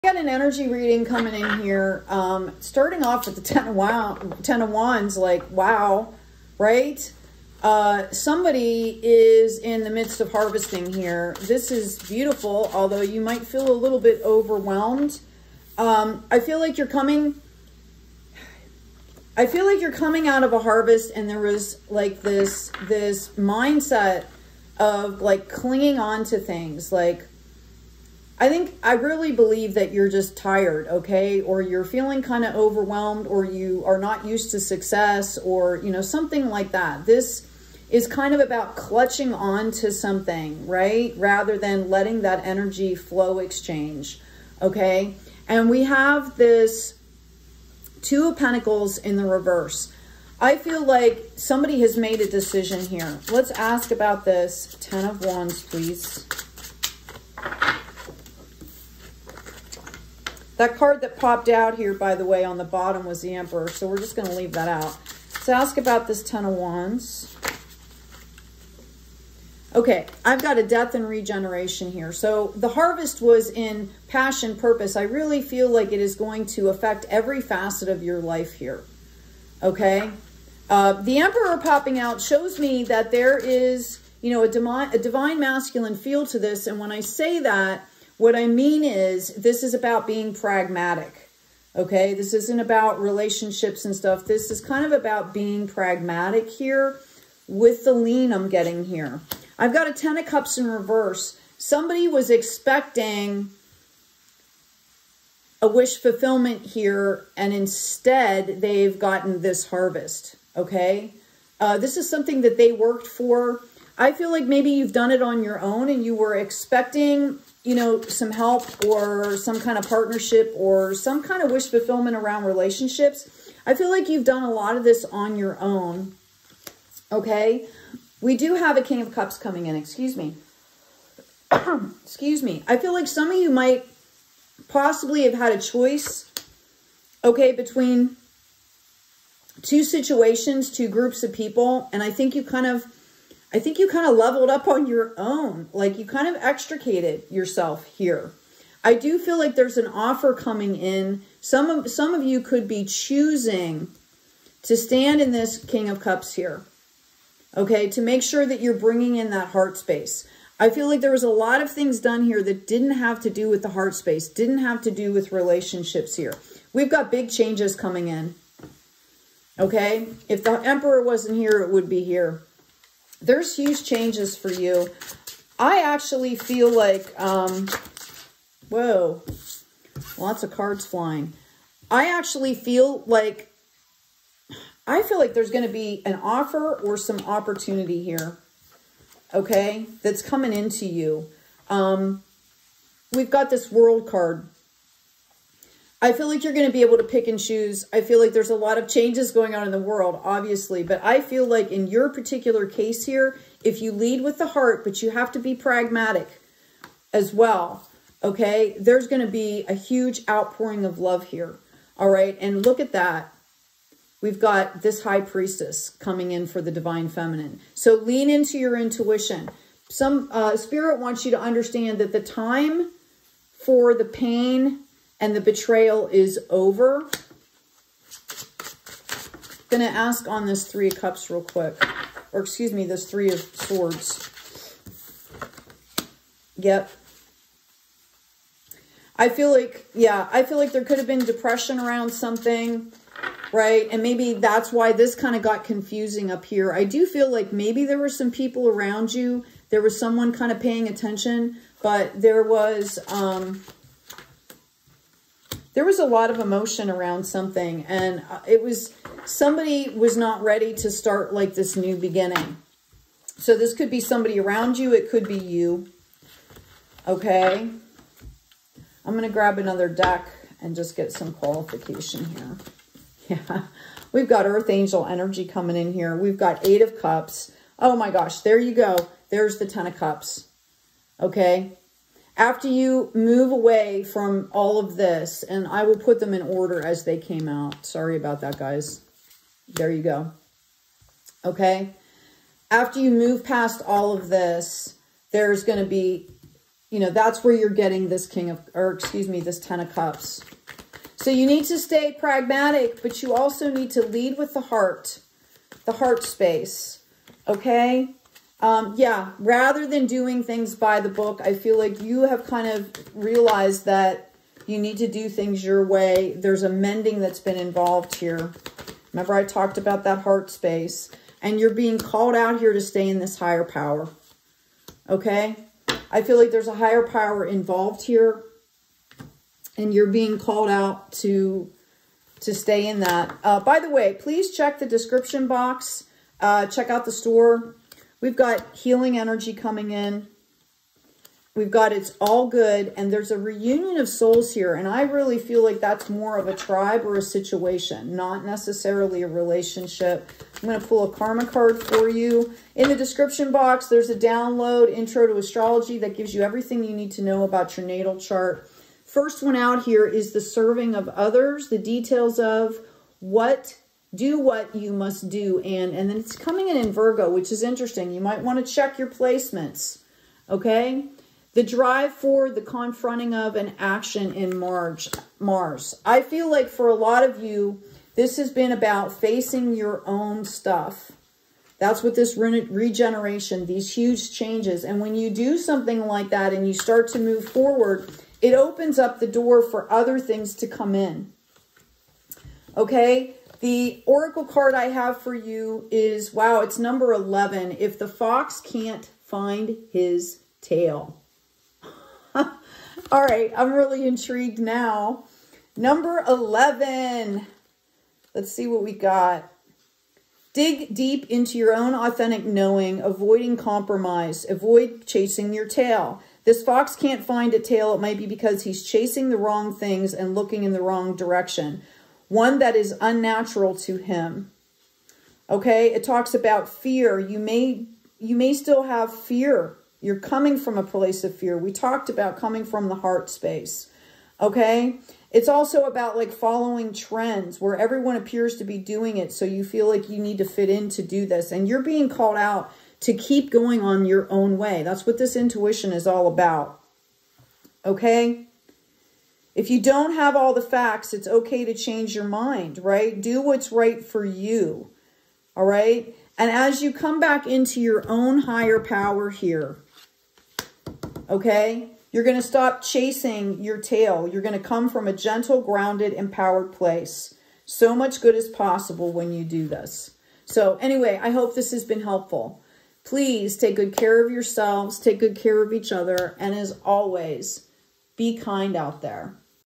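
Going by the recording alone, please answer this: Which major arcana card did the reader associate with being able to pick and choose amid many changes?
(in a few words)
The World.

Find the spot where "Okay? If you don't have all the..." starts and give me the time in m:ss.
7:27.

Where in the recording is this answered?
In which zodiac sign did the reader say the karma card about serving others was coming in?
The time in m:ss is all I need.
6:06.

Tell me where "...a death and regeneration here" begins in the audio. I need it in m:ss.
1:10.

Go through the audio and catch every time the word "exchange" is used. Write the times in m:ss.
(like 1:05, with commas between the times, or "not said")
0:43.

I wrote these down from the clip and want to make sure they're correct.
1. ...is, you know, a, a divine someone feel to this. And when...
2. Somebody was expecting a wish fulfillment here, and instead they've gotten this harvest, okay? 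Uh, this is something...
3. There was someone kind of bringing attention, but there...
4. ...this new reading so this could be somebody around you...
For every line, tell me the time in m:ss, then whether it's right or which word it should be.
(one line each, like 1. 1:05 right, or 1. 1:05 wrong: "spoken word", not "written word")
1. 1:23 wrong: "masculine", not "someone"
2. 1:41 right
3. 4:09 wrong: "paying", not "bringing"
4. 4:21 wrong: "beginning", not "reading".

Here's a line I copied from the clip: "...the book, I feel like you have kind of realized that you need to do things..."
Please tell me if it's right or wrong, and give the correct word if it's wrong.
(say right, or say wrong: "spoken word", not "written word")
right.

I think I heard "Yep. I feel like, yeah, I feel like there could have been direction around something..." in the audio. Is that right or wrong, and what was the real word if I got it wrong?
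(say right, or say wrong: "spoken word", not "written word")
wrong: "depression", not "direction".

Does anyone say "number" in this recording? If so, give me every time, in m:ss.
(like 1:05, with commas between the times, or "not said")
6:36, 6:45.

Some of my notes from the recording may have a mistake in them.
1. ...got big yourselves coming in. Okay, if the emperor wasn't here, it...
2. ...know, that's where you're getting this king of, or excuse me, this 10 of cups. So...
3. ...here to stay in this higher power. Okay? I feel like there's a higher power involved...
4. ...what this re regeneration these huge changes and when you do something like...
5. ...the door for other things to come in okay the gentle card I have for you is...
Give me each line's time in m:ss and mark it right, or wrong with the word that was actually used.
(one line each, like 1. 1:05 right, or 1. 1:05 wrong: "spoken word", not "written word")
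1. 2:46 wrong: "changes", not "yourselves"
2. 4:56 right
3. 5:22 right
4. 6:22 right
5. 6:29 wrong: "oracle", not "gentle".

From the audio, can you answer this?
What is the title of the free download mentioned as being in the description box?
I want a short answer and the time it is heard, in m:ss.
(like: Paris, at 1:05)
Intro to Astrology, at 5:54.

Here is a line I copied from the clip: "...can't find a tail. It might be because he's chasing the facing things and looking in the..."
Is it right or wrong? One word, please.
wrong.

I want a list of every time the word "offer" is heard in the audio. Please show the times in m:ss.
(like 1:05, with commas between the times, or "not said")
2:29, 3:06.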